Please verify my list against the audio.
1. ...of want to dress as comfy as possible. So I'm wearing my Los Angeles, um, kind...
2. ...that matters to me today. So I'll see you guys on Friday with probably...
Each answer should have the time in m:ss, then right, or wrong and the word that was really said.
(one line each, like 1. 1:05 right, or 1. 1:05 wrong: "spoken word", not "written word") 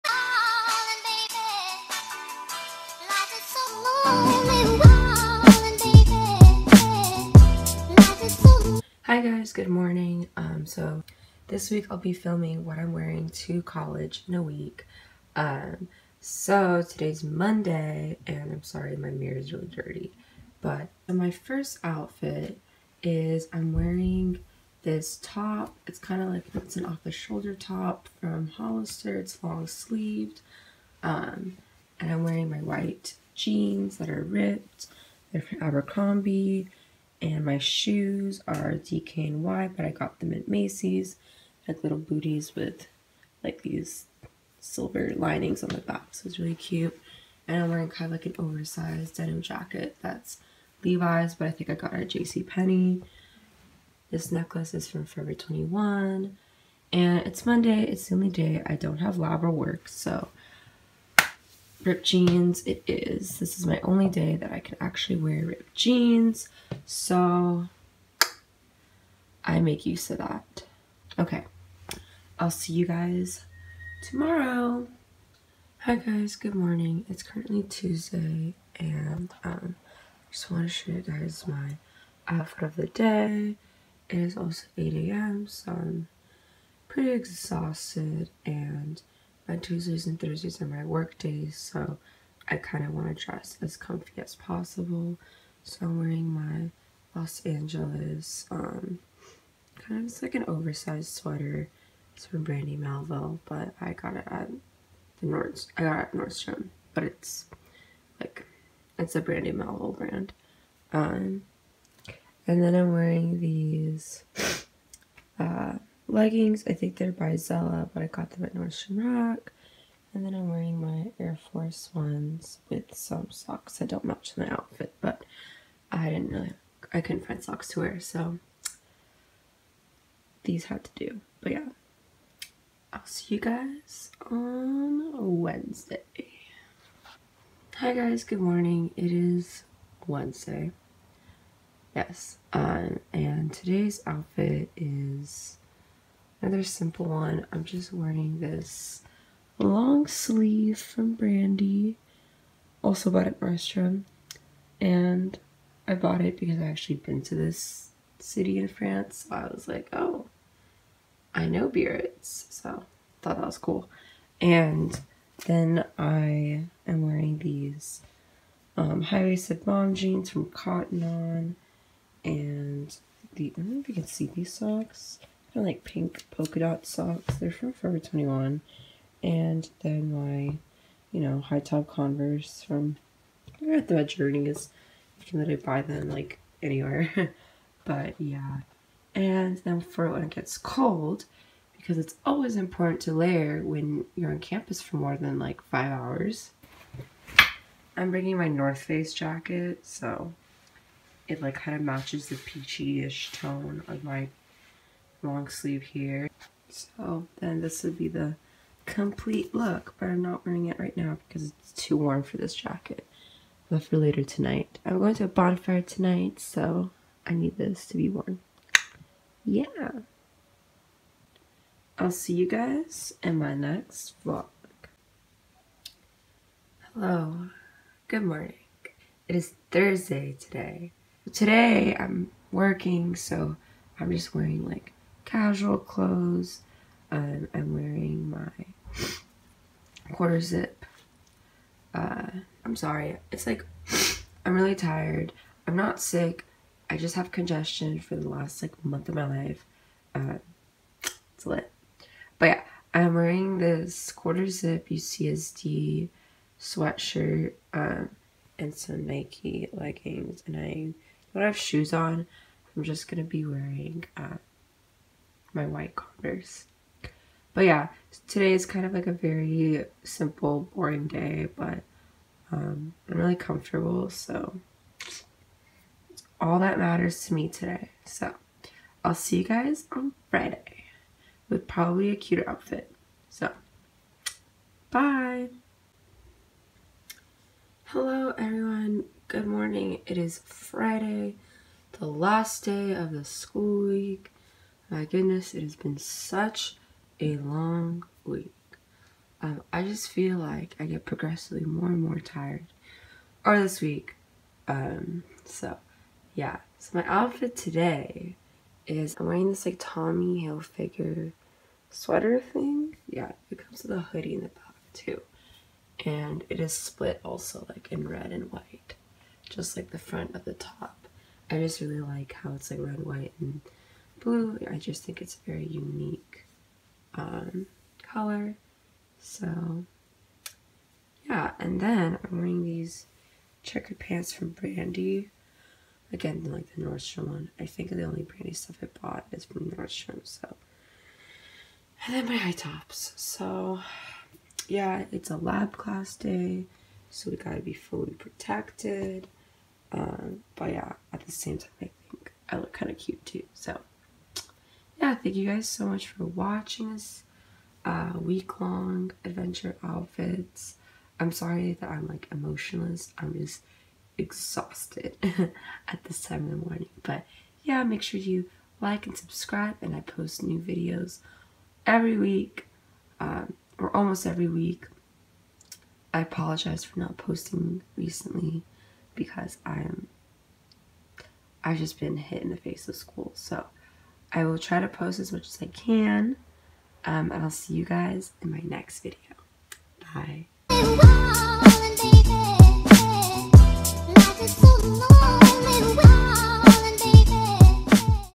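1. 1:32 right
2. 4:36 right.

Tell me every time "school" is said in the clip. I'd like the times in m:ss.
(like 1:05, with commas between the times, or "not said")
4:53, 6:22.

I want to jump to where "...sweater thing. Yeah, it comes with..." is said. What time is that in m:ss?
5:11.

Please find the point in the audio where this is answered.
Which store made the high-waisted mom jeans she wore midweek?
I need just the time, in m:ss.
2:50.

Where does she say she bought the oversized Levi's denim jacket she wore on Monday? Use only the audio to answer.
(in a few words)
JCPenney.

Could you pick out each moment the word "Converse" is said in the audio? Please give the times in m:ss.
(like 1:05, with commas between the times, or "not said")
3:01, 4:25.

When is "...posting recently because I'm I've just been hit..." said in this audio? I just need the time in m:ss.
6:17.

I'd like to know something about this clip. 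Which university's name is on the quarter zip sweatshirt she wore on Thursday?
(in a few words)
UCSD.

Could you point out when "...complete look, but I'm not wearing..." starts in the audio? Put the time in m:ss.
3:28.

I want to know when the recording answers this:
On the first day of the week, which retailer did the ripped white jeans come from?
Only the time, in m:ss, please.
0:35.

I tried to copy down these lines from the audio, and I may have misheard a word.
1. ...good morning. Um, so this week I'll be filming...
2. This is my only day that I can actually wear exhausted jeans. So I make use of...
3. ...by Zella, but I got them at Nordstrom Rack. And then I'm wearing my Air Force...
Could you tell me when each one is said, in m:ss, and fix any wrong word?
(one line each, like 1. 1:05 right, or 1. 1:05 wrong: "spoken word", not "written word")
1. 0:09 right
2. 1:03 wrong: "ripped", not "exhausted"
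3. 1:57 right.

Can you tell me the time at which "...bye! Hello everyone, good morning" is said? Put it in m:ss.
4:44.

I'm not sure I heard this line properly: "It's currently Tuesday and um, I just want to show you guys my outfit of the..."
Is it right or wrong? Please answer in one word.
right.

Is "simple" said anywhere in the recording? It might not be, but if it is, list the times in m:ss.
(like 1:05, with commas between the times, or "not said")
2:26, 4:30.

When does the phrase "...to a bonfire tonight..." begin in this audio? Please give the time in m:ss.
3:35.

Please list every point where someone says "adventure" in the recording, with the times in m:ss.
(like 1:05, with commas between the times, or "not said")
5:59.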